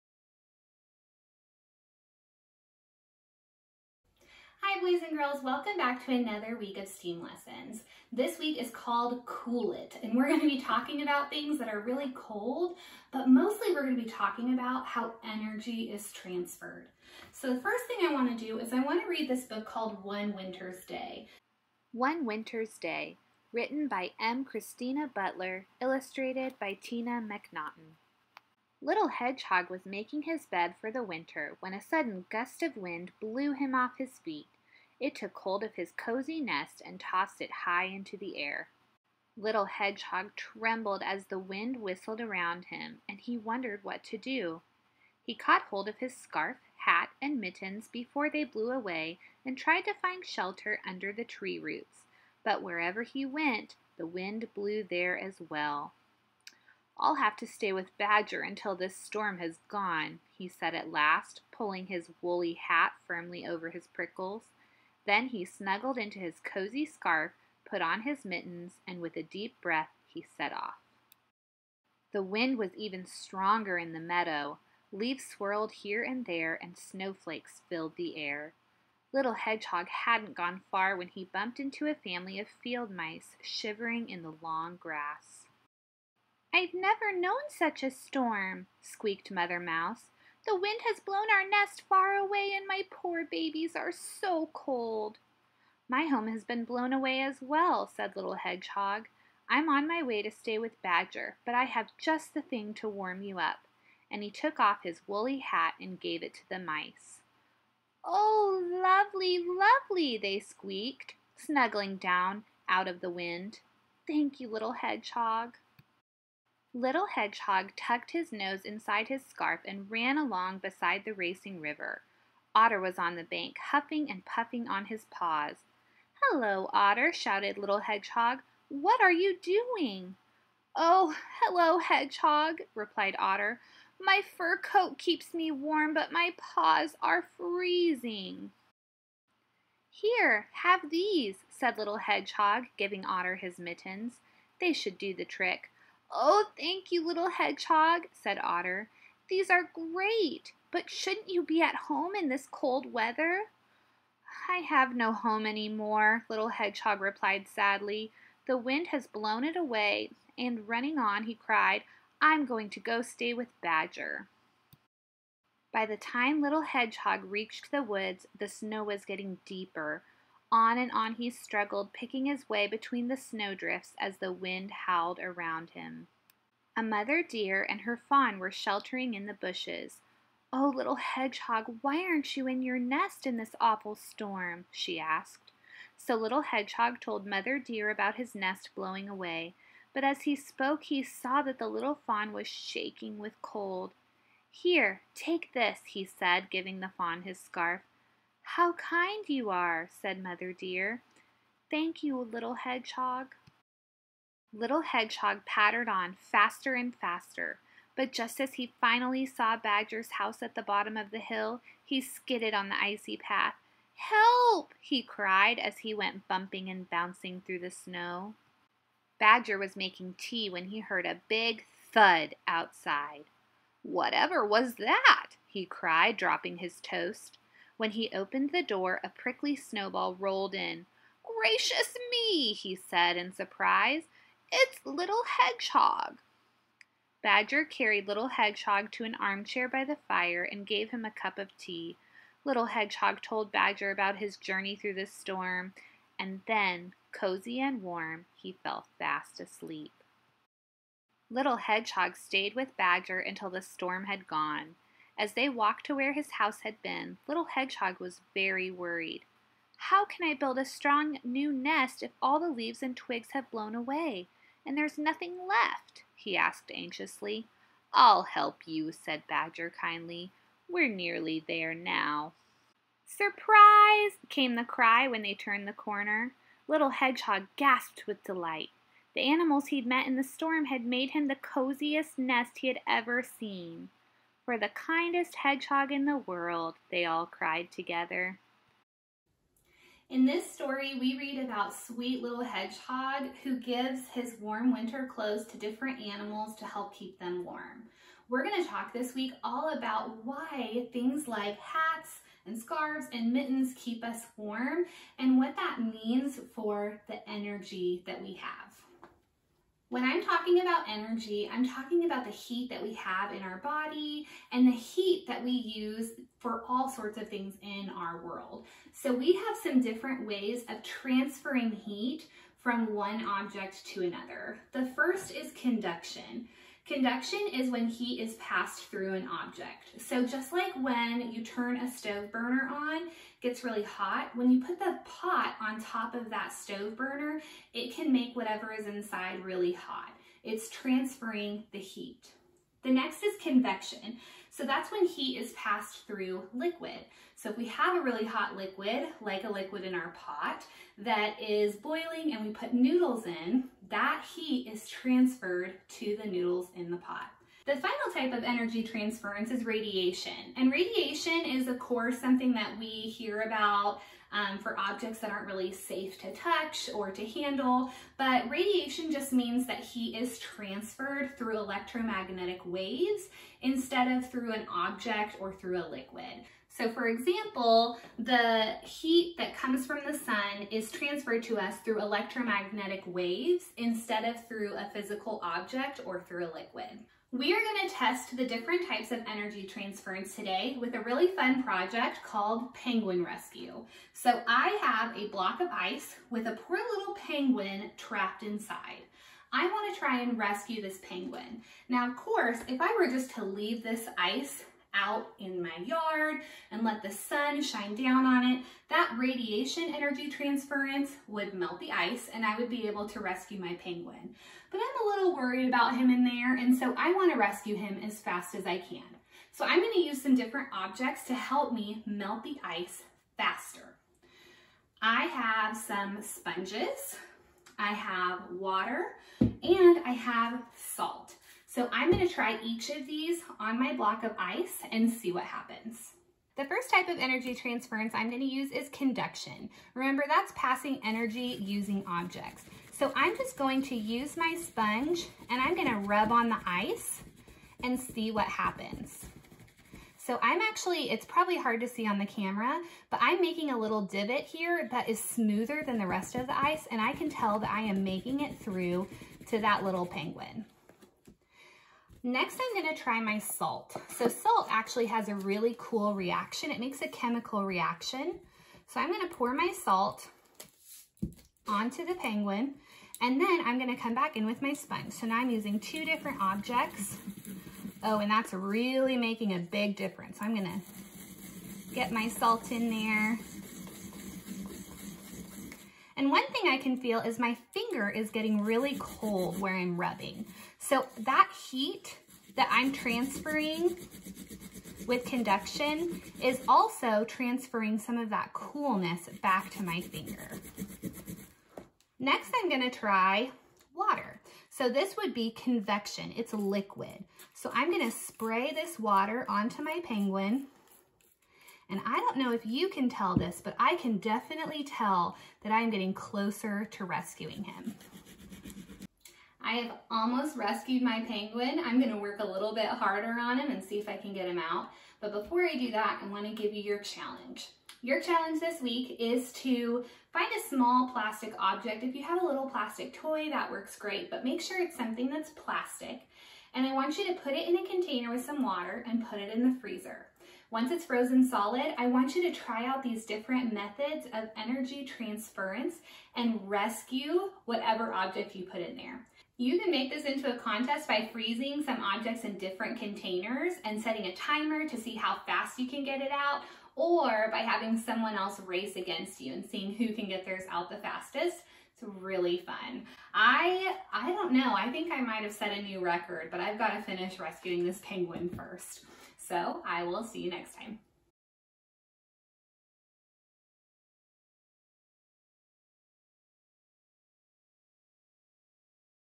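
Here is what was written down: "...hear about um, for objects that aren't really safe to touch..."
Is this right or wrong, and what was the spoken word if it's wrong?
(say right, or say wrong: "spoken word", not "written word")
right.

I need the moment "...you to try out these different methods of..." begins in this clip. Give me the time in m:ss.
9:02.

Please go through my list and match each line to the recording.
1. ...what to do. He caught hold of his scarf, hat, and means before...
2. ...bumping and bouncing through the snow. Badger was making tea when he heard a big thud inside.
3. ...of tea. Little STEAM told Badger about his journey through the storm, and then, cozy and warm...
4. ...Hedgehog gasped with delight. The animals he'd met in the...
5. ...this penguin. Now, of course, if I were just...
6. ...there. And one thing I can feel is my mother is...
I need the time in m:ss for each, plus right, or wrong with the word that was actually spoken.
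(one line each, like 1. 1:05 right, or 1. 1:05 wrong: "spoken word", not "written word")
1. 0:43 wrong: "mittens", not "means"
2. 3:36 wrong: "outside", not "inside"
3. 4:01 wrong: "Hedgehog", not "STEAM"
4. 4:36 right
5. 6:40 right
6. 8:02 wrong: "finger", not "mother".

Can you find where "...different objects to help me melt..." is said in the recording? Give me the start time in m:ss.
7:00.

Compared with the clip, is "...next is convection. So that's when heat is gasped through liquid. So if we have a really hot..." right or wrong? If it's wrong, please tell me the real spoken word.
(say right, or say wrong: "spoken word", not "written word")
wrong: "passed", not "gasped".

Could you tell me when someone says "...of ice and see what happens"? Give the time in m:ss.
7:14.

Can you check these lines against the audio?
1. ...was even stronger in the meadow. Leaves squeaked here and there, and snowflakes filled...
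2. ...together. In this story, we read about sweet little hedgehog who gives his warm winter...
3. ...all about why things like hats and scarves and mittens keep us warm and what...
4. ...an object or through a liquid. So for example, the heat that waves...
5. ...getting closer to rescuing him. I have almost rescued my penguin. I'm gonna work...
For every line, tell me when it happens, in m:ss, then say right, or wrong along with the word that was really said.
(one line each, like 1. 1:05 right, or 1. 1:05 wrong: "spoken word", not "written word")
1. 1:12 wrong: "swirled", not "squeaked"
2. 4:47 right
3. 4:59 right
4. 6:14 wrong: "comes", not "waves"
5. 8:35 right.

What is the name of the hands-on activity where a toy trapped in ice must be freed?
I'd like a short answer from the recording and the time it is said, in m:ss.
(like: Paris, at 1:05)
Penguin Rescue, at 6:32.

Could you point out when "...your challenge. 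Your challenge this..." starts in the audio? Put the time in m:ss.
8:46.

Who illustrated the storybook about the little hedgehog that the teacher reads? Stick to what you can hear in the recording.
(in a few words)
Tina Macnaughton.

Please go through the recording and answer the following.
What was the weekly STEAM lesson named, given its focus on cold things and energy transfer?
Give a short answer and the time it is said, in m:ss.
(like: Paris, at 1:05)
Cool It, at 0:09.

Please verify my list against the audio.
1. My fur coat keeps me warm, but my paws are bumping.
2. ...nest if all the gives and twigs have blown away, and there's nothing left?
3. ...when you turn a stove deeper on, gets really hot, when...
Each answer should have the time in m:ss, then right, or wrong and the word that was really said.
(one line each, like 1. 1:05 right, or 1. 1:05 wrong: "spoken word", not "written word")
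1. 2:13 wrong: "freezing", not "bumping"
2. 4:21 wrong: "leaves", not "gives"
3. 5:30 wrong: "burner", not "deeper".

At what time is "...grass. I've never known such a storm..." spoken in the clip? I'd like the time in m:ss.
1:24.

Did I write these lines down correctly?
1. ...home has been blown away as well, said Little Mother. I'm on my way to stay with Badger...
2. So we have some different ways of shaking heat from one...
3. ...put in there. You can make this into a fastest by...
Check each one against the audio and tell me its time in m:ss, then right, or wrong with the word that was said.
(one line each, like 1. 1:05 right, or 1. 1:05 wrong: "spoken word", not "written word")
1. 1:36 wrong: "Hedgehog", not "Mother"
2. 5:18 wrong: "transferring", not "shaking"
3. 9:08 wrong: "contest", not "fastest".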